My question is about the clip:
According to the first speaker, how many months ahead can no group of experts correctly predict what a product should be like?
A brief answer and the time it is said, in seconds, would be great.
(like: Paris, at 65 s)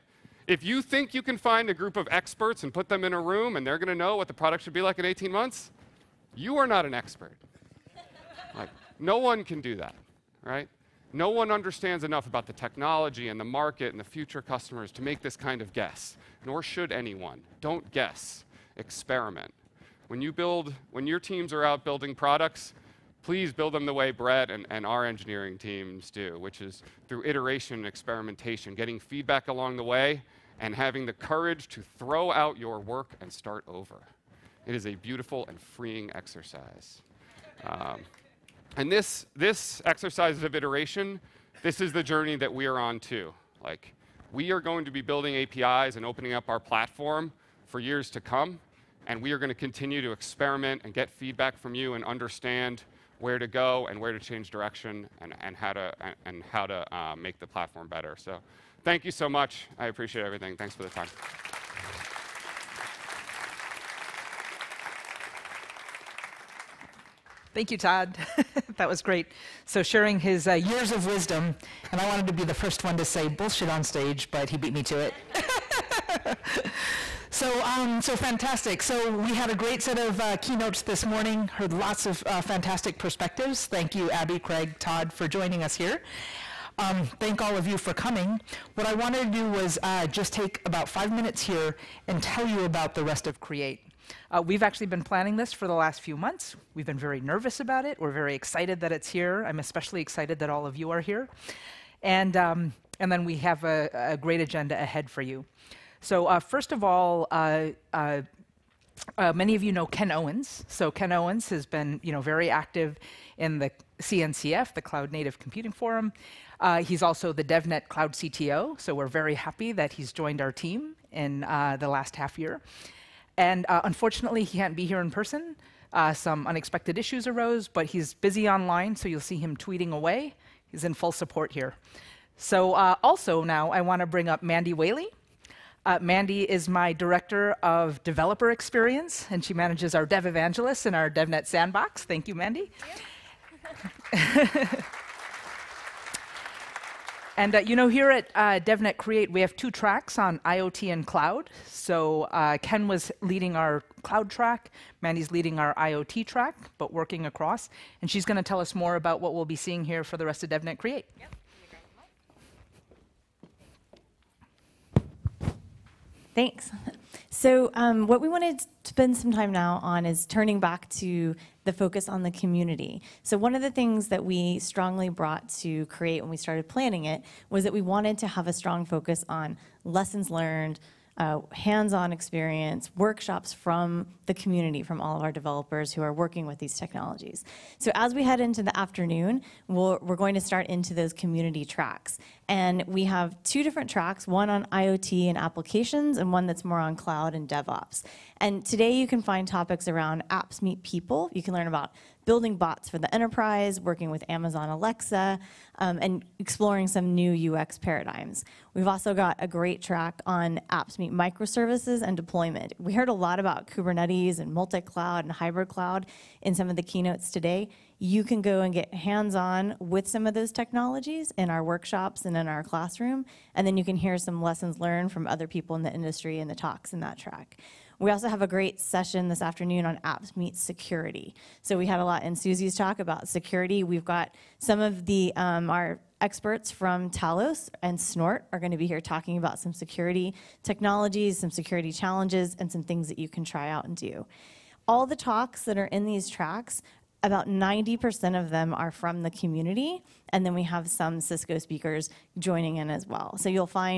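18, at 5 s.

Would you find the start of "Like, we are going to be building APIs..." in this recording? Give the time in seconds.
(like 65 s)
43 s.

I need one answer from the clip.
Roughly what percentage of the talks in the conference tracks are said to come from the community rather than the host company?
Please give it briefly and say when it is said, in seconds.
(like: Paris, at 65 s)
90%, at 247 s.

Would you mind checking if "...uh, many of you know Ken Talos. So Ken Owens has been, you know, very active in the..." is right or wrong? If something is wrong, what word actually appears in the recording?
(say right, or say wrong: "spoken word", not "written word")
wrong: "Owens", not "Talos".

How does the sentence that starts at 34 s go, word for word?
It is a beautiful and freeing exercise.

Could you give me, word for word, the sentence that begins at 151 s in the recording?
So uh, Ken was leading our cloud track, Mandy's leading our IoT track, but working across.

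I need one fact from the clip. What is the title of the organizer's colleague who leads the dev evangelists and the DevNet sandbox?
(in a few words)
Director of developer experience.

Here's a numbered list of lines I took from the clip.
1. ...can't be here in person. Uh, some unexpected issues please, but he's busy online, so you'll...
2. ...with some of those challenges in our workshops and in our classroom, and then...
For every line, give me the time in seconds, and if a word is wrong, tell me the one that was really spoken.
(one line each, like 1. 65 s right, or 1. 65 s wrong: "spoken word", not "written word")
1. 124 s wrong: "arose", not "please"
2. 219 s wrong: "technologies", not "challenges".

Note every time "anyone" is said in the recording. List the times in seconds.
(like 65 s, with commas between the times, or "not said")
16 s.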